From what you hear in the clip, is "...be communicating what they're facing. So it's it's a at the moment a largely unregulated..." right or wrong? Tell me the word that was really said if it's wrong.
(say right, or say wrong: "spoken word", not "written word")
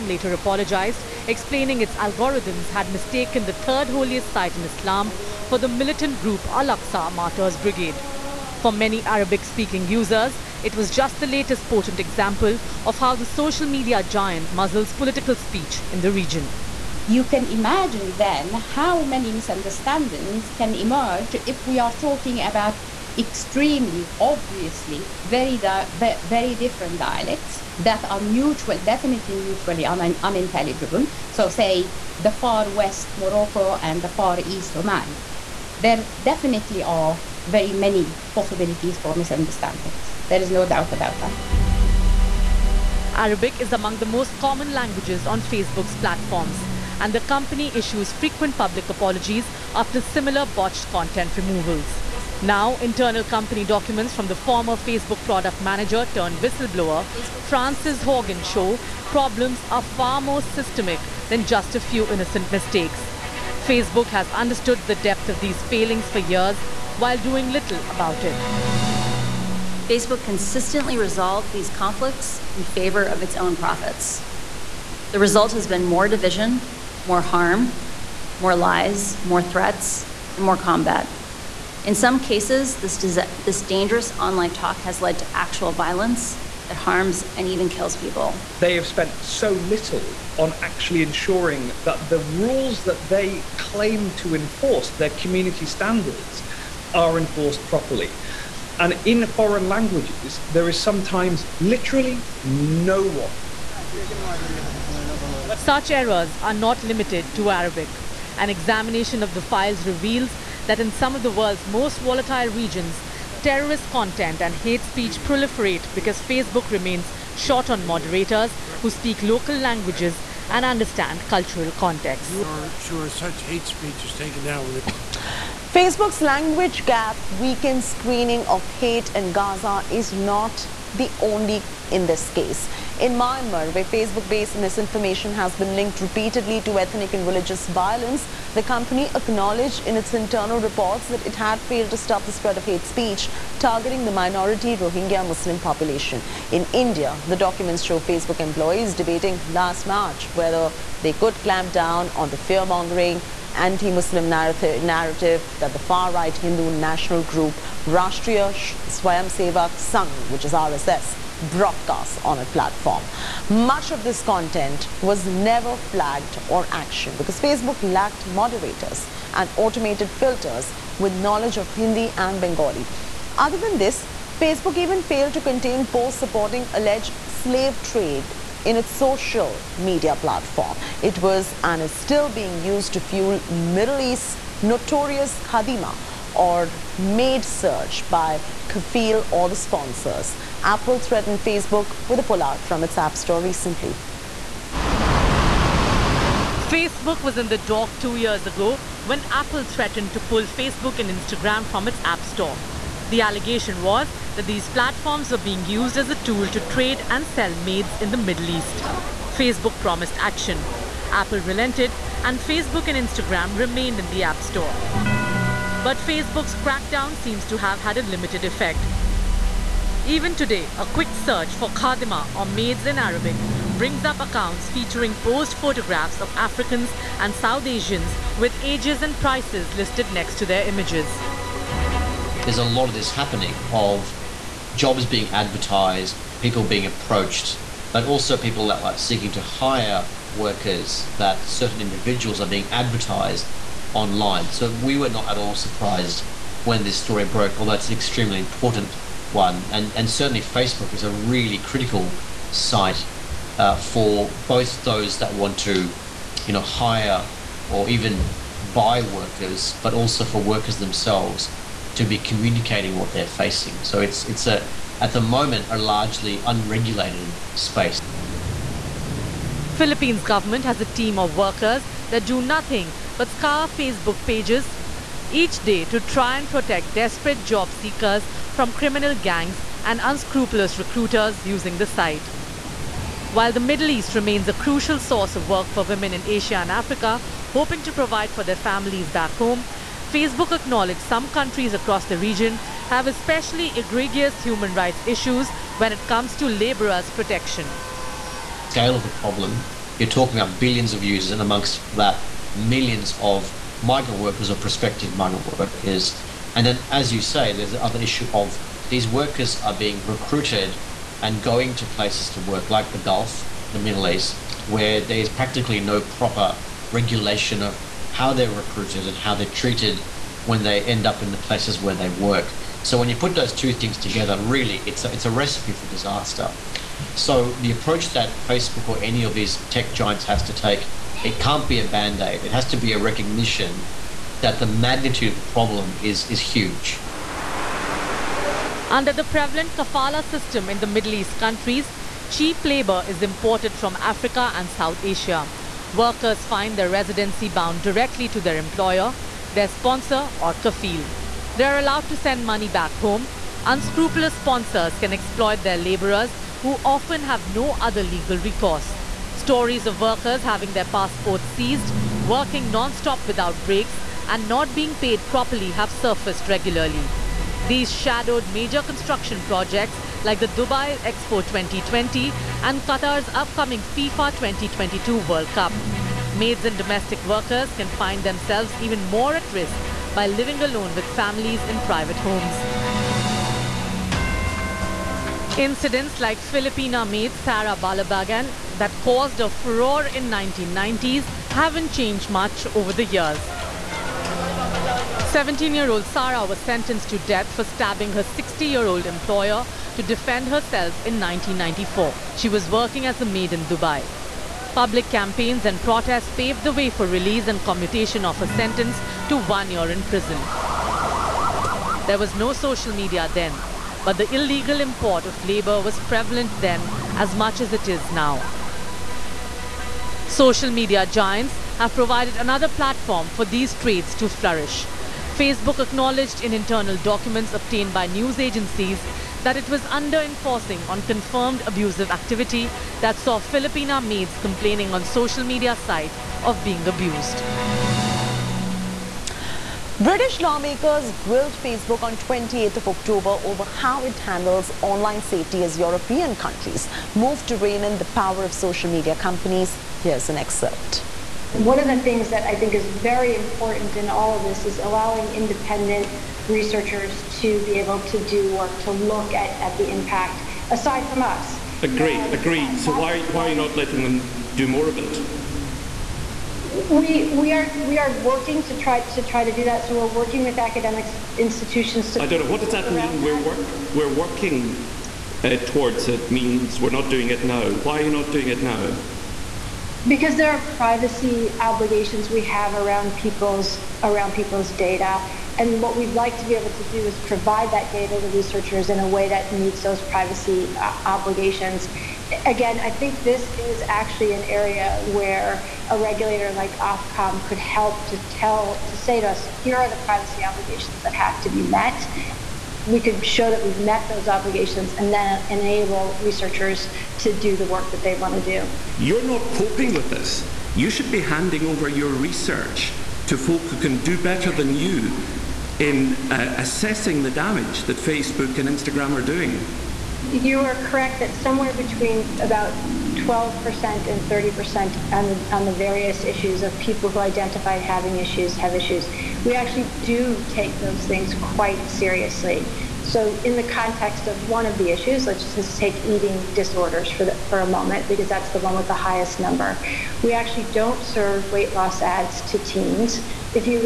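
right.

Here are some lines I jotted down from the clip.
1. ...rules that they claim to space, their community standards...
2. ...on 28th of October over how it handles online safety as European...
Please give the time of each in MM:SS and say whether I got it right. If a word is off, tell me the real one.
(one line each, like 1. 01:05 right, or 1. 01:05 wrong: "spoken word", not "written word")
1. 01:32 wrong: "enforce", not "space"
2. 07:22 right.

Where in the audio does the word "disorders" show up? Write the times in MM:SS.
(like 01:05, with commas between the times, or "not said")
08:56.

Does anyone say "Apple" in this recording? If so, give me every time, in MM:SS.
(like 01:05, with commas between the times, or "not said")
03:10, 03:19, 03:31.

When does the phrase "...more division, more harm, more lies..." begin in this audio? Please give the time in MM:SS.
01:15.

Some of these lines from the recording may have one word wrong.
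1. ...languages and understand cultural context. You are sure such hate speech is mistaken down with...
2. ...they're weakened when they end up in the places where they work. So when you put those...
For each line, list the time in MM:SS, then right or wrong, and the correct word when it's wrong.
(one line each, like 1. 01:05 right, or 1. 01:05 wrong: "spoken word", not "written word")
1. 01:59 wrong: "taken", not "mistaken"
2. 05:19 wrong: "treated", not "weakened".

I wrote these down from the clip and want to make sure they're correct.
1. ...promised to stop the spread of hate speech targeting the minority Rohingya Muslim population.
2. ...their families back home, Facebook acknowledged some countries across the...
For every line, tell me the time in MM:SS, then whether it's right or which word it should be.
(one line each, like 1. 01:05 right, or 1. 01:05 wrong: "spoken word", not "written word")
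1. 02:21 wrong: "failed", not "promised"
2. 04:48 right.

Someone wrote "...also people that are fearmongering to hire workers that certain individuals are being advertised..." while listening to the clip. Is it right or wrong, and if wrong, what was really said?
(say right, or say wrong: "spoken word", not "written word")
wrong: "seeking", not "fearmongering".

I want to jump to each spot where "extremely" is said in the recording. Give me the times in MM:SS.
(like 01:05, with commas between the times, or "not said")
00:23, 04:07.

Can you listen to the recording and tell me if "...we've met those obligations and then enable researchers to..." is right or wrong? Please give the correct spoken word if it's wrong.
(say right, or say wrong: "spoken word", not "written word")
right.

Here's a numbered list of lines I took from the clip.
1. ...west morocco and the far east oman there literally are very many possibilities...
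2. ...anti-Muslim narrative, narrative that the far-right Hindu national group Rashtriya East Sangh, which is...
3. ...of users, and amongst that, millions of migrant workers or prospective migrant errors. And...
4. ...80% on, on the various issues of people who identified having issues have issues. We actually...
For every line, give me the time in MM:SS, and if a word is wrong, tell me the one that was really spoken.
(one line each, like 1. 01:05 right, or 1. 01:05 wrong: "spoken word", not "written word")
1. 00:32 wrong: "definitely", not "literally"
2. 02:33 wrong: "Swayamsevak", not "East"
3. 05:00 wrong: "workers", not "errors"
4. 08:44 wrong: "30", not "80".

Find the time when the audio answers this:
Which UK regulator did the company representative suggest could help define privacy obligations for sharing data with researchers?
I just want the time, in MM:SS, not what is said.
08:16.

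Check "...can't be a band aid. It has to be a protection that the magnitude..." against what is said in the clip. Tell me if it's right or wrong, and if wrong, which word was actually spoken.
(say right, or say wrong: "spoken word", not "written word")
wrong: "recognition", not "protection".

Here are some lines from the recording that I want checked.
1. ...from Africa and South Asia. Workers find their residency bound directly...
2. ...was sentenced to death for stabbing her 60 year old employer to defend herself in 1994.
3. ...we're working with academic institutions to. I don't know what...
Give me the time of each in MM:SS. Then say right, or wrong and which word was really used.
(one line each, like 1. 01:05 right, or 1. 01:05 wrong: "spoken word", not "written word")
1. 05:43 right
2. 06:36 right
3. 07:49 right.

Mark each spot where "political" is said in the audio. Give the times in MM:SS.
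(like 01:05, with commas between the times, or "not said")
00:14.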